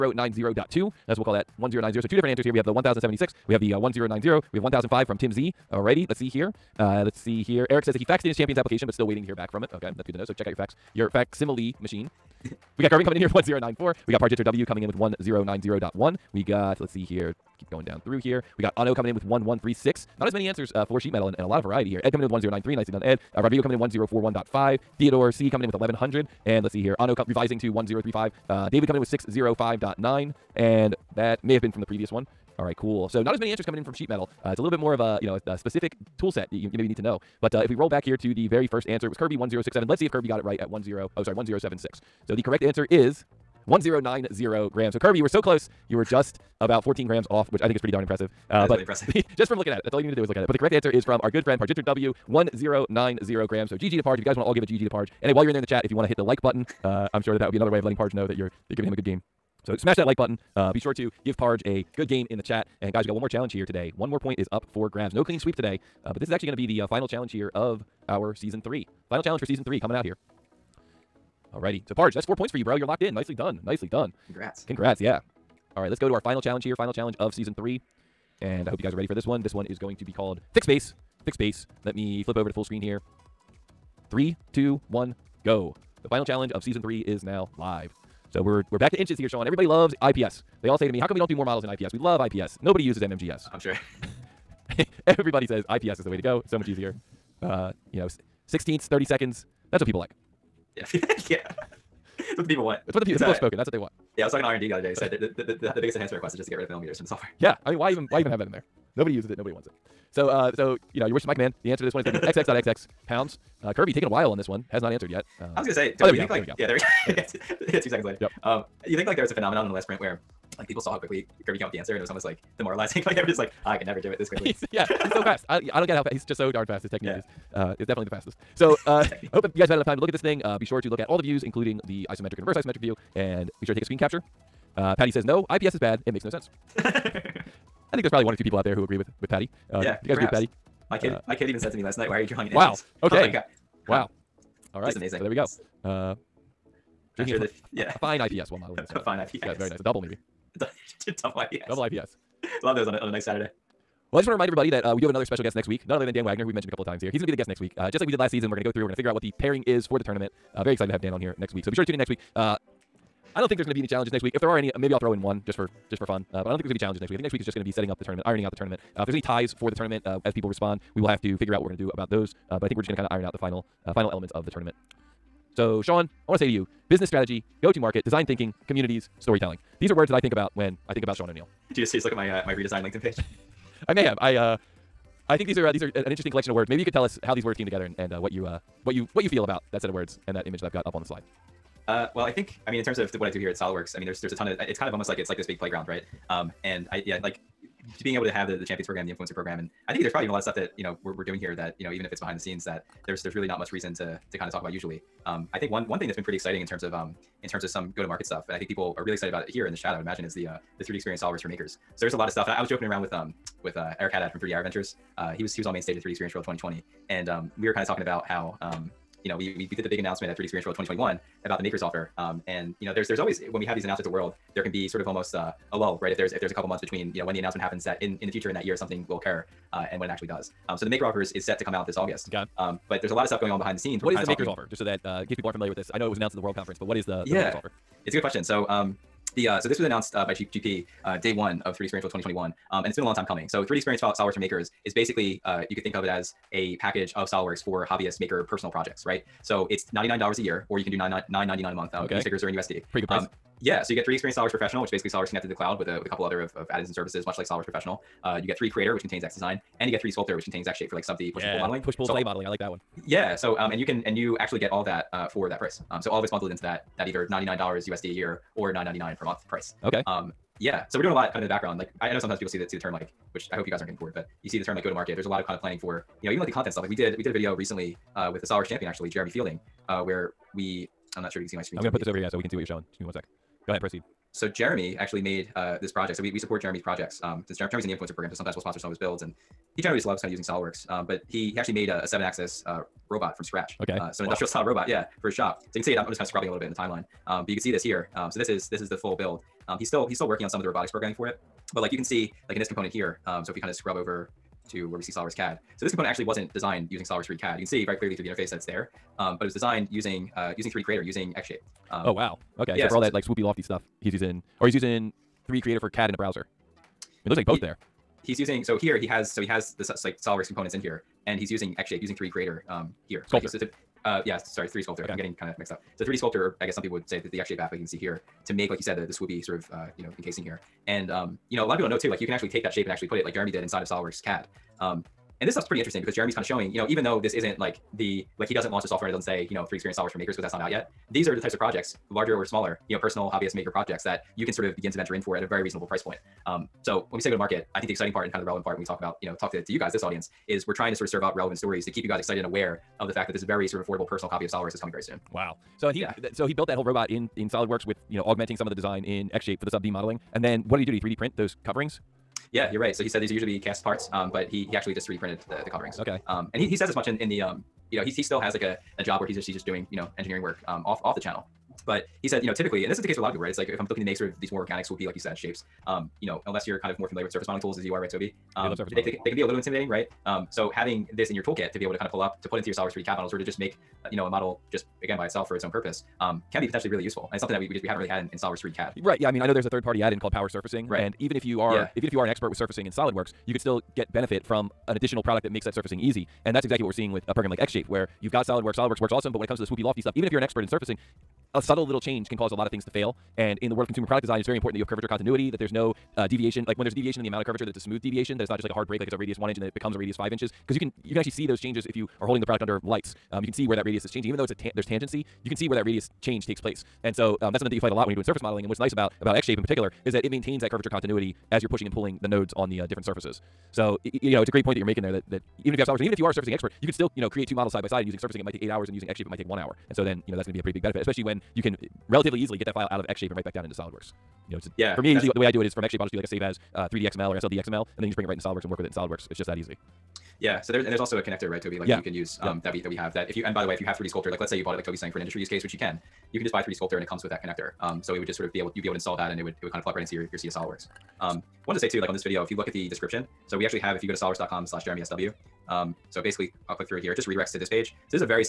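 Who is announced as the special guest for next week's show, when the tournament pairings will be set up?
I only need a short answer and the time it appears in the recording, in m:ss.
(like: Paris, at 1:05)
Dan Wagner, at 2:36.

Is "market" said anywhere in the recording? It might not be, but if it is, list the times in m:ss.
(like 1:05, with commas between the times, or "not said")
2:57, 3:28, 4:34, 5:47.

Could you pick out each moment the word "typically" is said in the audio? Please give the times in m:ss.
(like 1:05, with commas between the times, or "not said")
6:12.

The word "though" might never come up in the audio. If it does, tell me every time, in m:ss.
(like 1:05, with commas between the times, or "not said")
5:37, 6:54.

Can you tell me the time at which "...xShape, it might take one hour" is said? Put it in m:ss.
7:09.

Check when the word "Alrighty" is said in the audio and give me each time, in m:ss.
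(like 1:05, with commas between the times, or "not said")
0:05, 1:11.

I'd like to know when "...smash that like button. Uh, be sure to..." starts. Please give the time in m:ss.
0:59.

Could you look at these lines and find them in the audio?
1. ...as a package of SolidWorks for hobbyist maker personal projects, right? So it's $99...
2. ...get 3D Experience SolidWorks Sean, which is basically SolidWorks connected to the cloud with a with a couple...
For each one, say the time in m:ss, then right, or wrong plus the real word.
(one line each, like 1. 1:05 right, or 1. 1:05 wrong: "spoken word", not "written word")
1. 4:06 right
2. 4:13 wrong: "Professional", not "Sean".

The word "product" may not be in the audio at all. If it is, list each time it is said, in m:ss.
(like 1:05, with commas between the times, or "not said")
6:35, 6:44, 6:52.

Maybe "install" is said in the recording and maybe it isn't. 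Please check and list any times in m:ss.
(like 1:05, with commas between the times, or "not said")
7:28.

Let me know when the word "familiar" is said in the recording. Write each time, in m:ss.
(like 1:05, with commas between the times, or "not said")
3:55, 6:17.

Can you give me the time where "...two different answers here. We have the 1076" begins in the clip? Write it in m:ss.
0:02.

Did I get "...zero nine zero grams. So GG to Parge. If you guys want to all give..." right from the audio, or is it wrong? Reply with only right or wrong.
right.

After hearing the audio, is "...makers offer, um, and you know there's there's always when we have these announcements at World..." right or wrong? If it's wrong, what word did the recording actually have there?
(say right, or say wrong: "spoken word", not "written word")
right.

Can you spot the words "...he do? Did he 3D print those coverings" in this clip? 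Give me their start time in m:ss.
6:00.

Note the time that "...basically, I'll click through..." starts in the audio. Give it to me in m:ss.
7:36.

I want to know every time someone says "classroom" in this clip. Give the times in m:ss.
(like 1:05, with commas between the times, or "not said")
not said.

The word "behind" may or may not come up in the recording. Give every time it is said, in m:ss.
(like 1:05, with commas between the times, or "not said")
3:22, 3:53.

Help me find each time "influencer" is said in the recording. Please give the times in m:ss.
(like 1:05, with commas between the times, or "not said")
3:19, 4:47.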